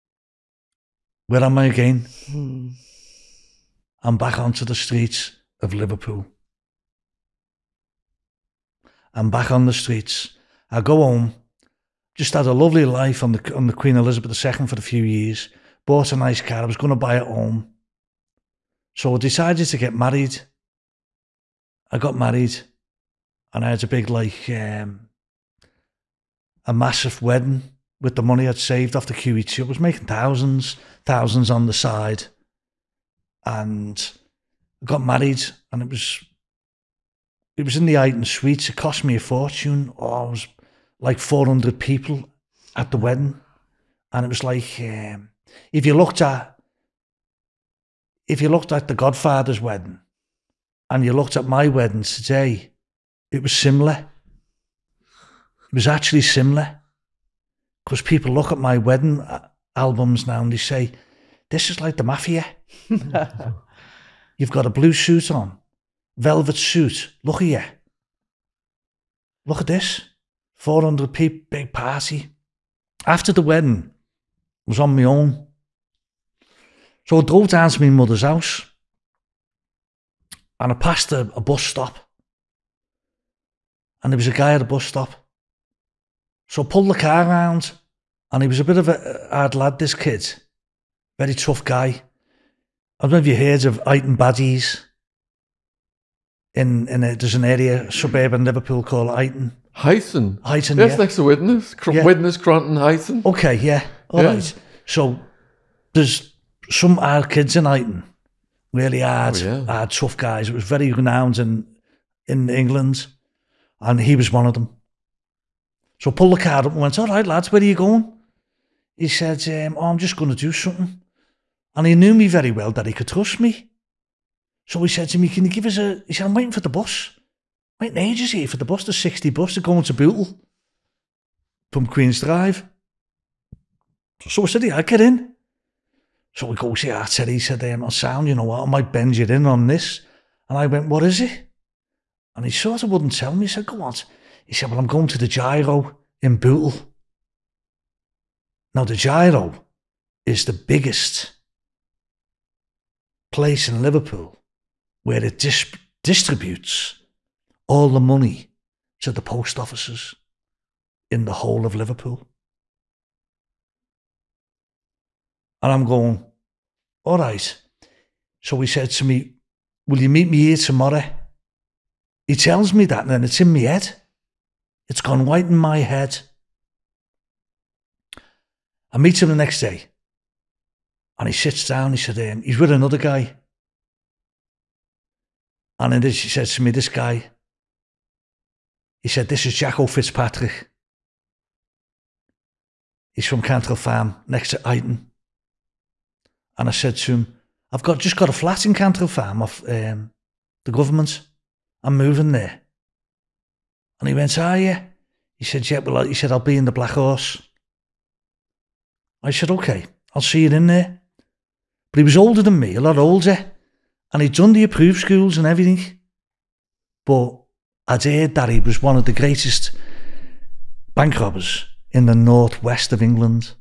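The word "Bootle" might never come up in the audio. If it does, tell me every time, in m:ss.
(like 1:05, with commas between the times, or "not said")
2:09, 2:26.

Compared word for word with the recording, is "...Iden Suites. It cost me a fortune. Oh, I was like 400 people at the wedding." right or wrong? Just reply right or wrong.
right.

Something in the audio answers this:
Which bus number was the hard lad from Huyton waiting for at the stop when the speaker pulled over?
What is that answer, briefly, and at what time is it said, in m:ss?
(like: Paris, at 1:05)
60, at 2:08.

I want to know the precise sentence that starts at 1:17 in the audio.
So I drove down to my mother's house and I passed a, a bus stop.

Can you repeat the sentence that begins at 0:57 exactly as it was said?
Because people look at my wedding uh, albums now and they say, this is like the mafia.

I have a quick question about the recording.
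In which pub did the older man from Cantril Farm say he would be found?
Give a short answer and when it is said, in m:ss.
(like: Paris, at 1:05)
the Black Horse, at 3:26.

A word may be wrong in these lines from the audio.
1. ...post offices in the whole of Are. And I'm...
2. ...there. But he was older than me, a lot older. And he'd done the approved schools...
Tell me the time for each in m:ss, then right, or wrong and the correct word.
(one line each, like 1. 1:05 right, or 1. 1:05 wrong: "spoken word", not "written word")
1. 2:39 wrong: "Liverpool", not "Are"
2. 3:30 right.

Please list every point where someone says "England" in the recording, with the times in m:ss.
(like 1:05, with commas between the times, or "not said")
1:52, 3:43.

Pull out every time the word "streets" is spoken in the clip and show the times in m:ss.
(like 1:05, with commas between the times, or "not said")
0:04, 0:09.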